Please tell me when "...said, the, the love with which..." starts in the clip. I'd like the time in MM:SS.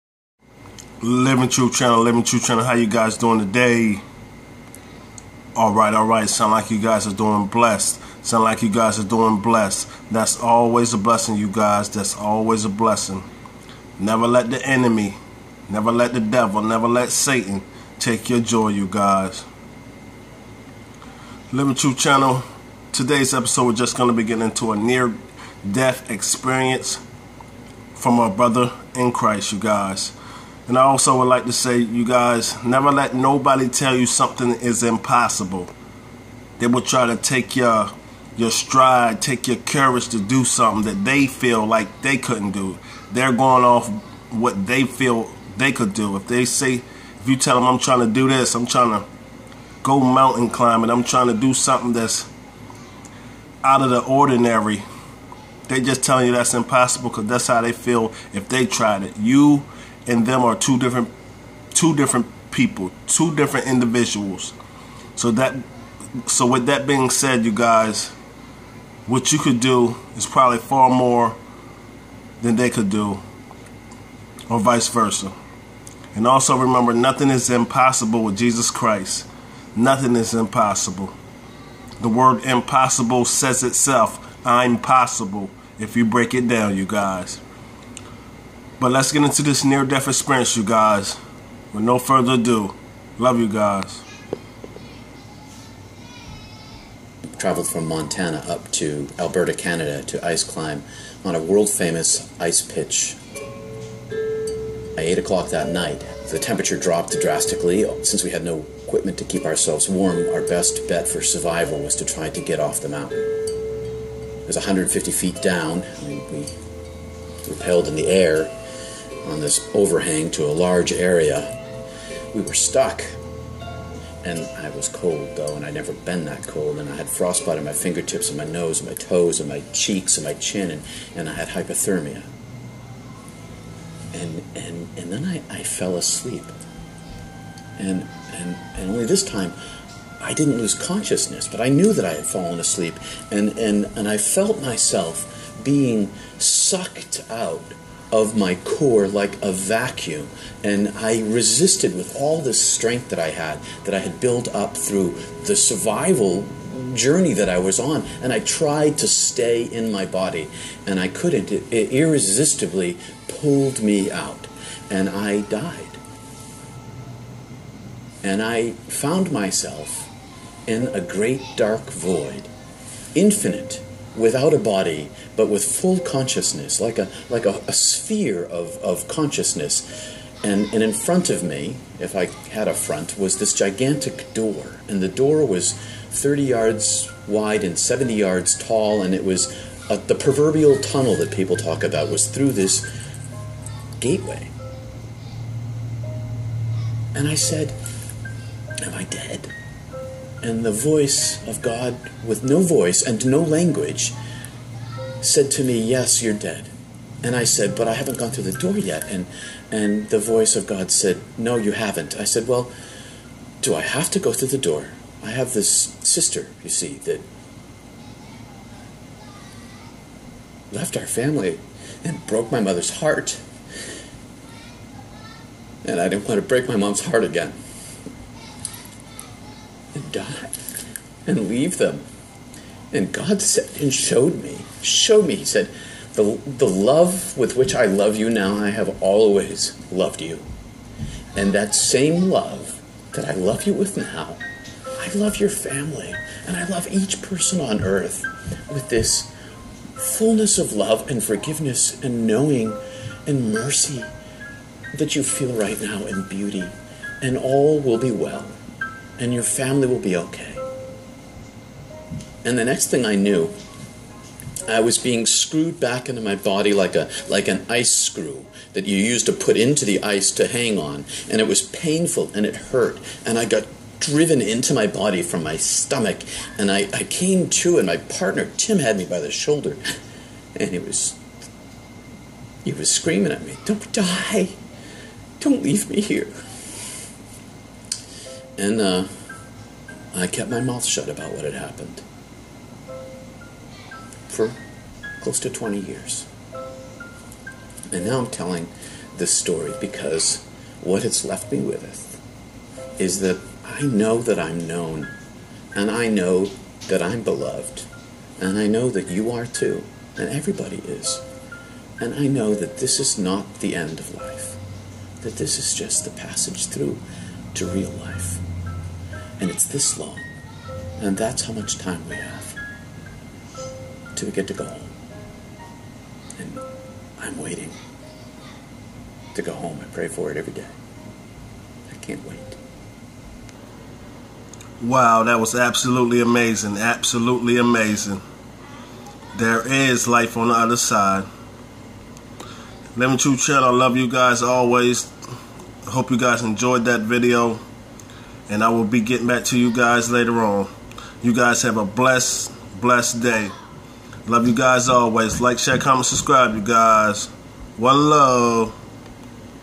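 03:55.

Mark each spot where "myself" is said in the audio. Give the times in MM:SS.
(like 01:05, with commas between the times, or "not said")
02:24, 02:49.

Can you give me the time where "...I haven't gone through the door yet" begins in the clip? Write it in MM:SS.
03:27.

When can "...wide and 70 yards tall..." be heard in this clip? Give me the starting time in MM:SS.
03:07.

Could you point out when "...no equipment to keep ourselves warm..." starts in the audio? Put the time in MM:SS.
01:48.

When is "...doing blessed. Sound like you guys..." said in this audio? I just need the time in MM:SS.
00:07.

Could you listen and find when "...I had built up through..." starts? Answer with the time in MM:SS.
02:33.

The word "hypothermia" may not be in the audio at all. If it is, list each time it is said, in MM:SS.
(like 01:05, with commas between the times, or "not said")
02:11.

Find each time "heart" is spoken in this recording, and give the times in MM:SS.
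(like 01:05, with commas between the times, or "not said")
03:42, 03:47.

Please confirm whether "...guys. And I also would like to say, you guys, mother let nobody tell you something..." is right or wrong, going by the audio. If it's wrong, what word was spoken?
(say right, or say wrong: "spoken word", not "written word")
wrong: "never", not "mother".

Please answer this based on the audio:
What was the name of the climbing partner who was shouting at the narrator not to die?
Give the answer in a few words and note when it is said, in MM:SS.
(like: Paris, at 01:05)
Tim, at 04:38.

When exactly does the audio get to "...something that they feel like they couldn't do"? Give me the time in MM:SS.
00:40.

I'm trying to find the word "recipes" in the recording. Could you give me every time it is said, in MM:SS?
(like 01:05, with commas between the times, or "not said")
not said.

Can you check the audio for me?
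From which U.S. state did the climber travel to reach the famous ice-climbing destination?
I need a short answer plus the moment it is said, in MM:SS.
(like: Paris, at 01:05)
Montana, at 01:37.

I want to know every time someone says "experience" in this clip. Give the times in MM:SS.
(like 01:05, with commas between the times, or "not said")
00:26, 01:30.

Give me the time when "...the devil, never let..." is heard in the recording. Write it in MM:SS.
00:16.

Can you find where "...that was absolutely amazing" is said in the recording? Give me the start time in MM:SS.
05:35.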